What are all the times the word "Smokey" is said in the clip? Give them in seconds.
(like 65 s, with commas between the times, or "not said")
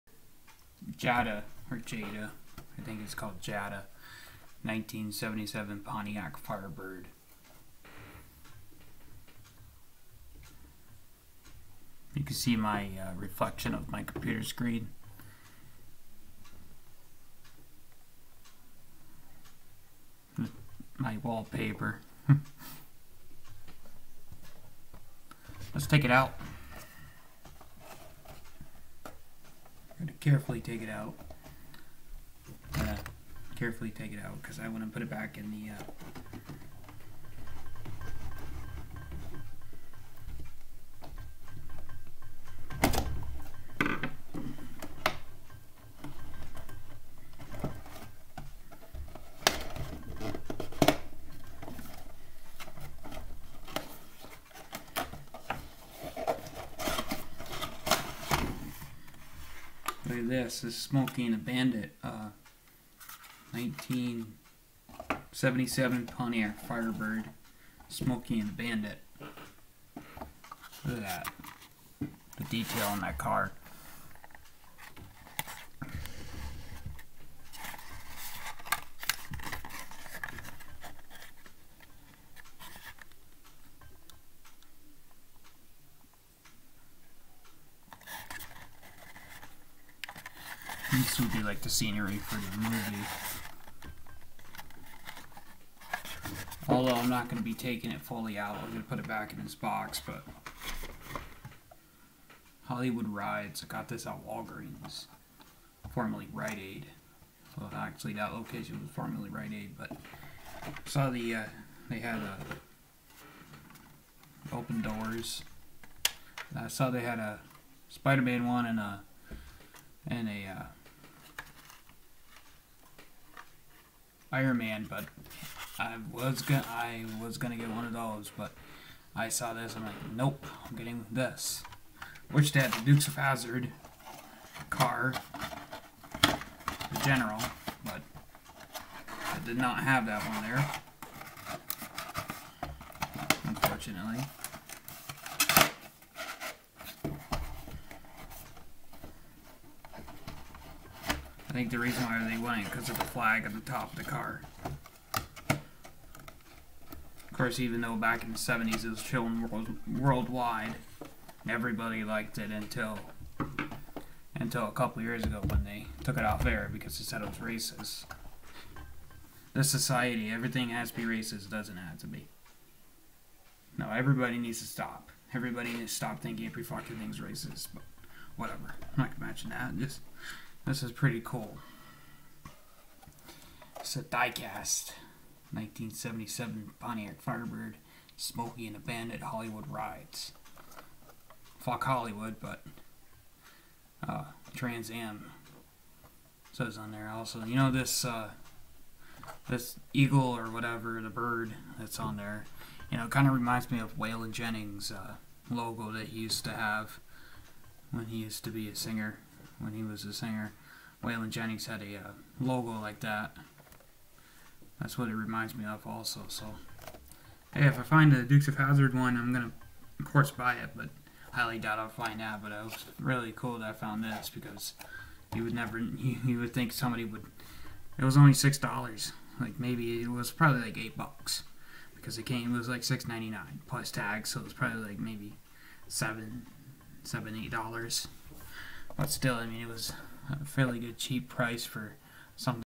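60 s, 67 s, 188 s.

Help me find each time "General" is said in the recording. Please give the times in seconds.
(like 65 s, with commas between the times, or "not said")
137 s.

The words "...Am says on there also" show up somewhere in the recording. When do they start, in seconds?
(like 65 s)
194 s.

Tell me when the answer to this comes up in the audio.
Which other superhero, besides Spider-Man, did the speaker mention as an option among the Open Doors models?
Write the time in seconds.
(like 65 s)
124 s.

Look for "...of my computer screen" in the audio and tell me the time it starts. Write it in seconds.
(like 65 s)
13 s.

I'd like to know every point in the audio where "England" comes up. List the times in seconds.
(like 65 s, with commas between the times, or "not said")
not said.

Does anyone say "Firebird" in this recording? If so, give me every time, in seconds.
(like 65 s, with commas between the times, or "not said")
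6 s, 66 s, 187 s.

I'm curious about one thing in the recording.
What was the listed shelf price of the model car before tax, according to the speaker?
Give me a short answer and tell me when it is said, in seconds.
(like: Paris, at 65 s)
$6.99, at 232 s.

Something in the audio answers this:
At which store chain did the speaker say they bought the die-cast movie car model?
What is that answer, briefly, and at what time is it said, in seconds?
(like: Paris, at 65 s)
Walgreens, at 104 s.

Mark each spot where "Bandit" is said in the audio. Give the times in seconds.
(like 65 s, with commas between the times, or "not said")
61 s, 68 s, 188 s.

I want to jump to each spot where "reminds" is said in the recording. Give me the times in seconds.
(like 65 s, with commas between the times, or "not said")
203 s, 215 s.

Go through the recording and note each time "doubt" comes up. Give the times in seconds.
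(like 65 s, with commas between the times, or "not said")
221 s.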